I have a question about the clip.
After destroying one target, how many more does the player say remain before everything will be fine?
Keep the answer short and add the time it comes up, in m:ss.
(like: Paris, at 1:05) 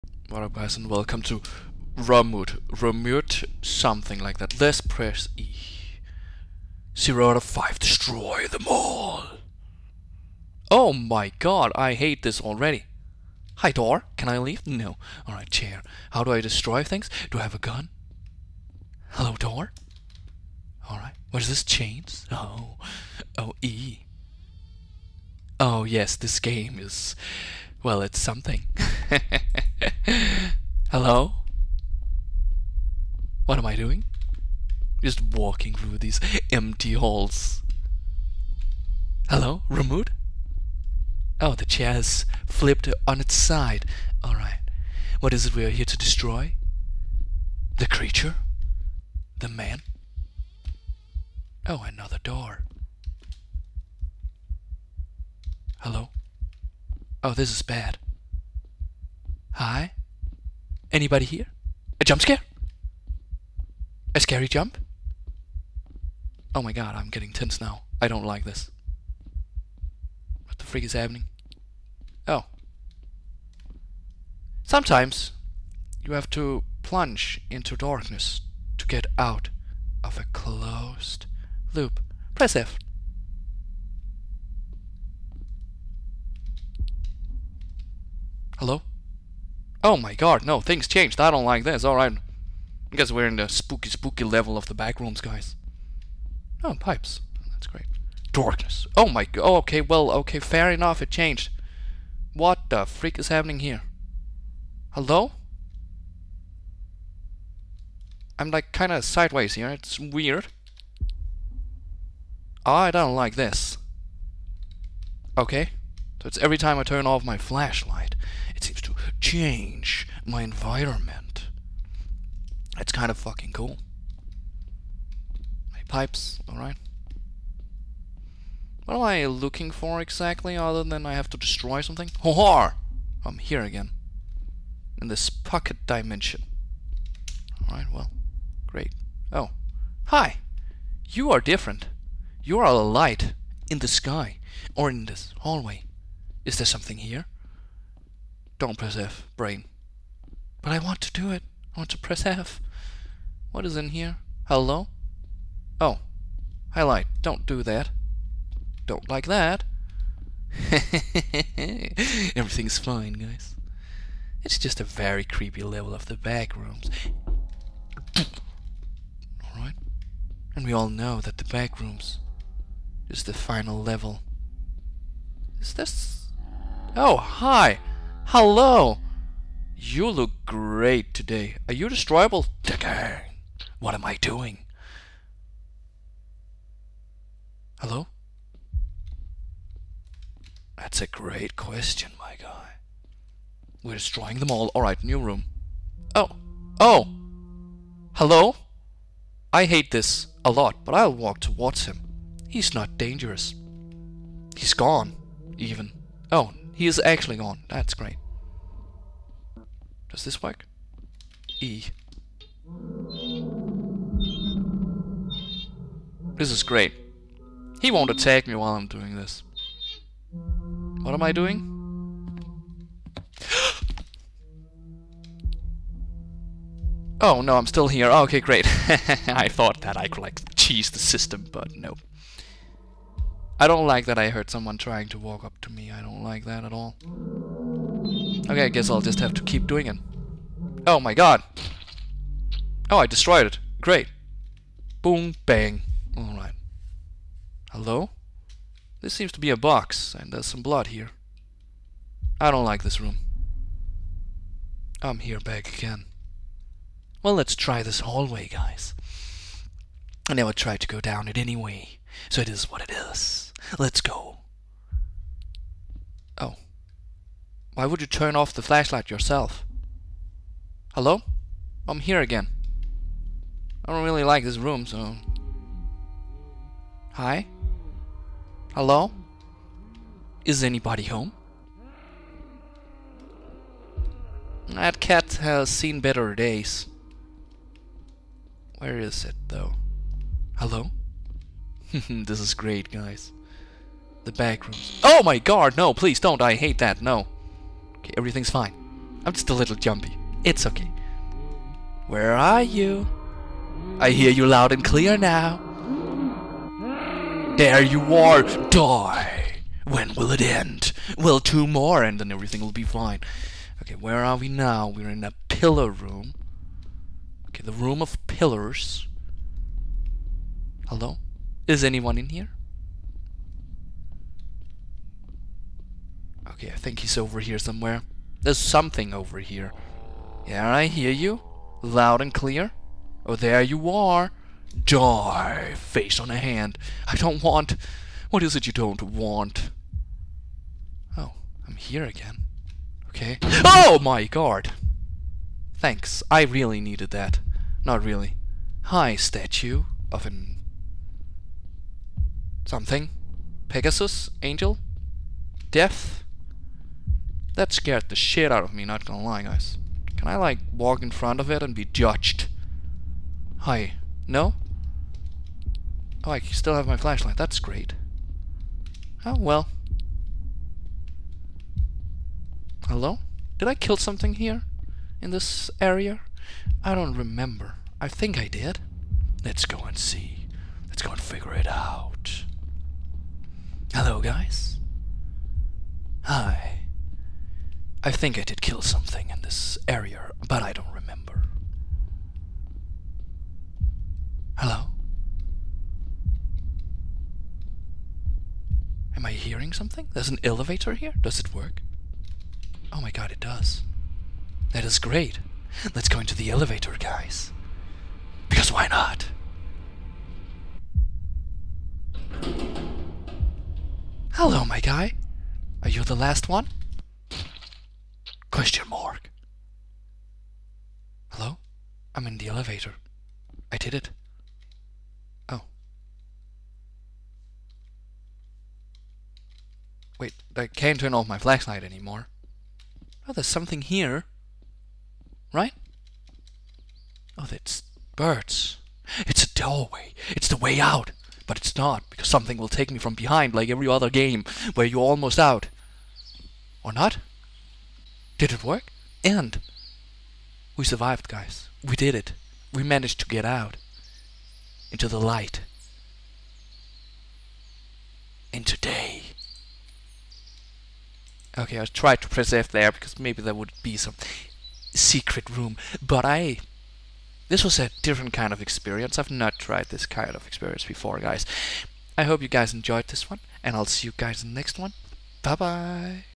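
2, at 5:11.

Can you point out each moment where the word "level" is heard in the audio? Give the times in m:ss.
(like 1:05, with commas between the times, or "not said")
1:34, 2:45, 2:53.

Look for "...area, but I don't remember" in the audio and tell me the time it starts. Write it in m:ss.
6:29.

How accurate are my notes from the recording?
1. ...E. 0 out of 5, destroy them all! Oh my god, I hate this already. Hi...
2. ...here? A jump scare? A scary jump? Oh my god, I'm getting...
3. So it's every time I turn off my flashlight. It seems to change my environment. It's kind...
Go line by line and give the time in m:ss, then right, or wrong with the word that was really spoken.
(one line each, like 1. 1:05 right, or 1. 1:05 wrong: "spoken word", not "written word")
1. 0:05 right
2. 1:01 right
3. 1:56 right.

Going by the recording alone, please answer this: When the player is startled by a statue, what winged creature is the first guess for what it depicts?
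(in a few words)
Pegasus.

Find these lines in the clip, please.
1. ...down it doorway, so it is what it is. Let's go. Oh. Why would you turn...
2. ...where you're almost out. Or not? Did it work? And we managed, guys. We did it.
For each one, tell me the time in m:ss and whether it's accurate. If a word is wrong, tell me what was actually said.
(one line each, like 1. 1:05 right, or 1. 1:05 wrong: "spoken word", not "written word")
1. 4:20 wrong: "anyway", not "doorway"
2. 7:24 wrong: "survived", not "managed".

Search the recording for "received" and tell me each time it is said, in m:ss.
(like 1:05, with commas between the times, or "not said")
not said.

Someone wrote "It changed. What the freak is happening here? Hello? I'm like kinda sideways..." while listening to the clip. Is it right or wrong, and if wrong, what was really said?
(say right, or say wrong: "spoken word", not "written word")
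right.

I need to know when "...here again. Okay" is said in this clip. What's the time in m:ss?
5:41.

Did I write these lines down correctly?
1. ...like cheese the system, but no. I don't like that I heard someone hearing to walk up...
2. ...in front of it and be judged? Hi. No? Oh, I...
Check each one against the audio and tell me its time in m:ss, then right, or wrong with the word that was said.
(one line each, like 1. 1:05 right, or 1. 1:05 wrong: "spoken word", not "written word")
1. 3:50 wrong: "trying", not "hearing"
2. 6:01 right.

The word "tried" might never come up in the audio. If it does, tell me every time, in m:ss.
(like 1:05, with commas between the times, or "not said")
4:20, 7:49.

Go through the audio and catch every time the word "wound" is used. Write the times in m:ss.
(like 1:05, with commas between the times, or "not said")
not said.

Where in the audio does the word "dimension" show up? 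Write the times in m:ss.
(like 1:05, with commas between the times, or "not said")
2:15.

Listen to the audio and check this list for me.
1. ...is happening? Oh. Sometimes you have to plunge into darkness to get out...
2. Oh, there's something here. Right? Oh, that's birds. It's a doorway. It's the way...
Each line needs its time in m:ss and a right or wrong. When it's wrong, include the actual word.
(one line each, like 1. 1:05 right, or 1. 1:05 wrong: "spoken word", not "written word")
1. 1:10 right
2. 7:13 right.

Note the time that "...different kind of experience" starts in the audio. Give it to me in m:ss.
7:48.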